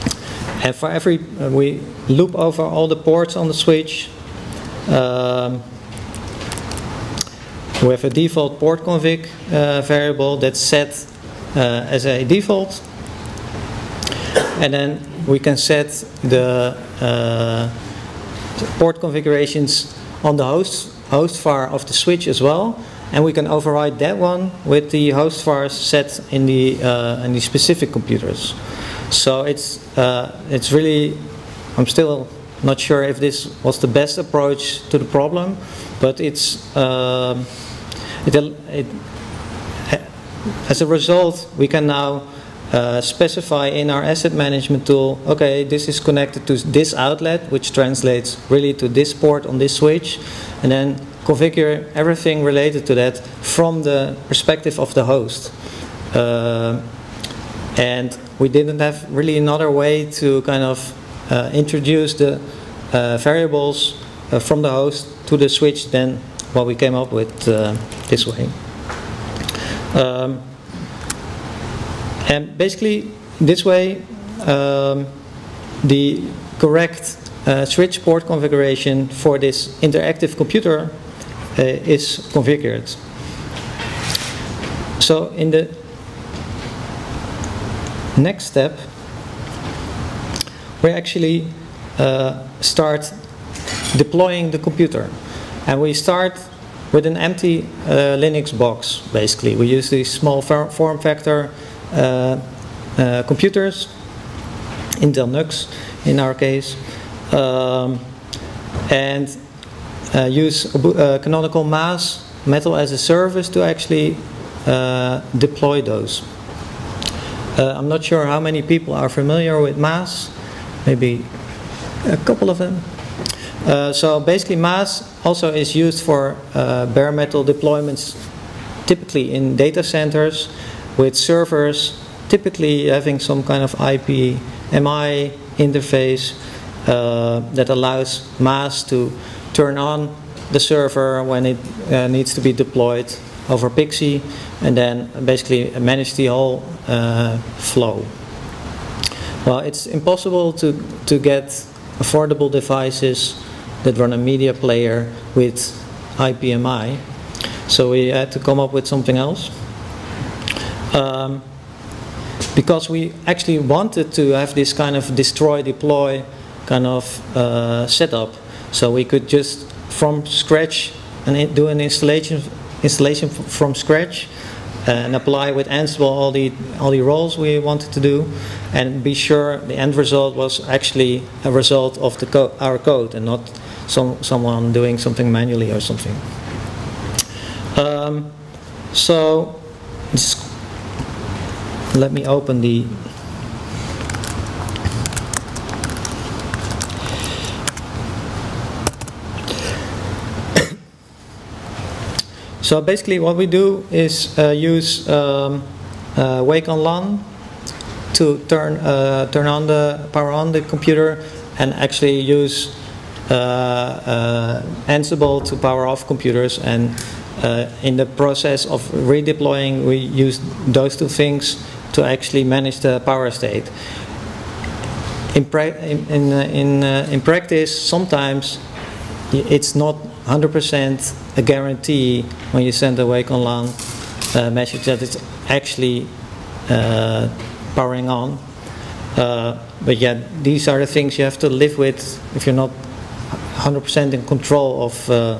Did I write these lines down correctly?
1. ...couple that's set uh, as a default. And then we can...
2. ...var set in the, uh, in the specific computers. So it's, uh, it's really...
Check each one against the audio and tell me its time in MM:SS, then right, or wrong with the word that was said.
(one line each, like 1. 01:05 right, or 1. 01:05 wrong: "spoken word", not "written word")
1. 00:09 wrong: "variable", not "couple"
2. 00:25 right.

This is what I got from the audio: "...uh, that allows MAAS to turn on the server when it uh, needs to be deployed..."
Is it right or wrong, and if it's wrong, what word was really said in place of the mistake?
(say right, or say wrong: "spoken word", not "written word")
right.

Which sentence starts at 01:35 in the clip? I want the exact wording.
And we start with an empty uh, Linux box, basically.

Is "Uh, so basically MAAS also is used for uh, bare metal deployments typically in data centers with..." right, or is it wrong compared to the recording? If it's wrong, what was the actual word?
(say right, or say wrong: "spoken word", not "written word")
right.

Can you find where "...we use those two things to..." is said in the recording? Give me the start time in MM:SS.
03:39.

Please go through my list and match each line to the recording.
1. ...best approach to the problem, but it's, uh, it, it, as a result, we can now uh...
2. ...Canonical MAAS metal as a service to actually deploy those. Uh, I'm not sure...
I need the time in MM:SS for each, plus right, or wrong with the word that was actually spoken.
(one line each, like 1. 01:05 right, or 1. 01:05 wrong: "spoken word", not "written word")
1. 00:33 right
2. 01:51 right.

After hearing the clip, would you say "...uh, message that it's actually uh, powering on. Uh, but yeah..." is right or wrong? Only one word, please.
right.